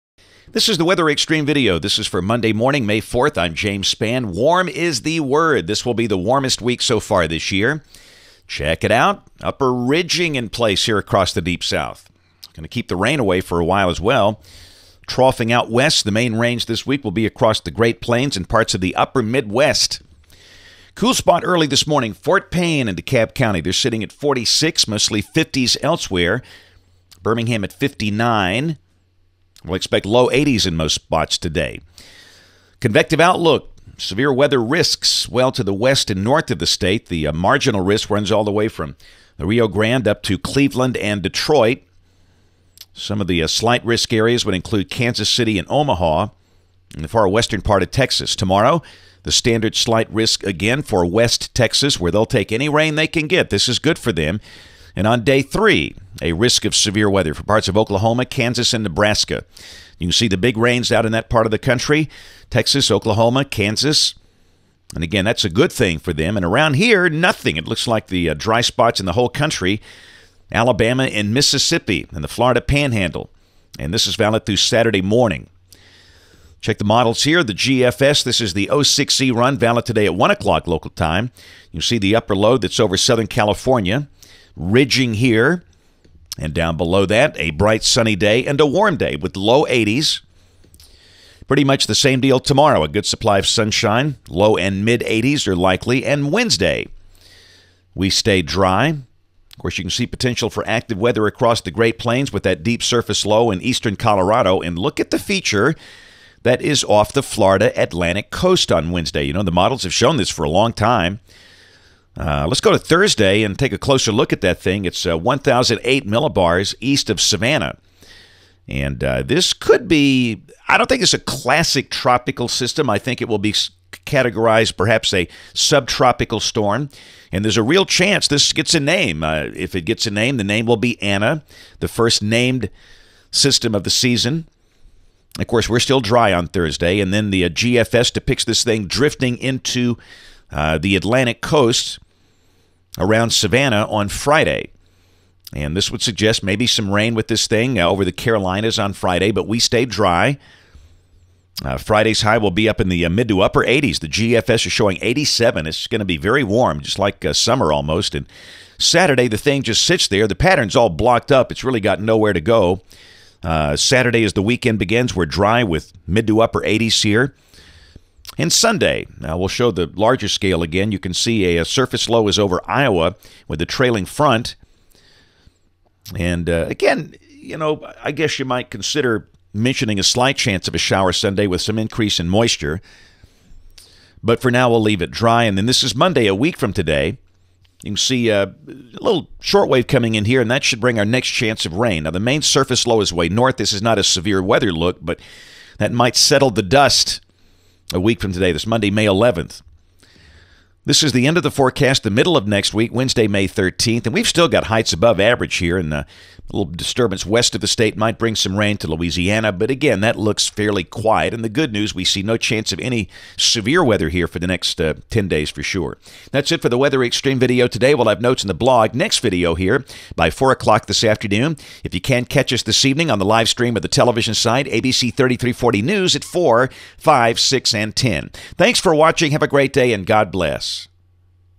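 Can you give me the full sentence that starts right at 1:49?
You know, the models have shown this for a long time.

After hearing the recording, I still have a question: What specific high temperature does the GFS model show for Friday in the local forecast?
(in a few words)
87.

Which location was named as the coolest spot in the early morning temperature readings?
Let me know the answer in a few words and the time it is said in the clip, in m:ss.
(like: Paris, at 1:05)
Fort Payne, at 0:22.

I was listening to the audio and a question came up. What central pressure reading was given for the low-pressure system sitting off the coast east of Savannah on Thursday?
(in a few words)
1,008 millibars.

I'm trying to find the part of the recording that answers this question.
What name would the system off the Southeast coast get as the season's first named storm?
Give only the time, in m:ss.
2:11.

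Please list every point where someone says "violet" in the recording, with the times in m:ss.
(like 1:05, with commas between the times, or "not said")
not said.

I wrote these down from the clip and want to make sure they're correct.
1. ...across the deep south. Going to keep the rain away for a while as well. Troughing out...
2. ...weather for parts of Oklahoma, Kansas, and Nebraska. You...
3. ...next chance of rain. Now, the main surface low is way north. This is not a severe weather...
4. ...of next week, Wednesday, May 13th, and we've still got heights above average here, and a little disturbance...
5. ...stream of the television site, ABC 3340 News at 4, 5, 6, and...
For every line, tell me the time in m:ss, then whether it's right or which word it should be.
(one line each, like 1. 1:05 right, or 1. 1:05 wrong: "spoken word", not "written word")
1. 0:10 right
2. 0:57 right
3. 3:11 right
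4. 3:22 right
5. 3:43 right.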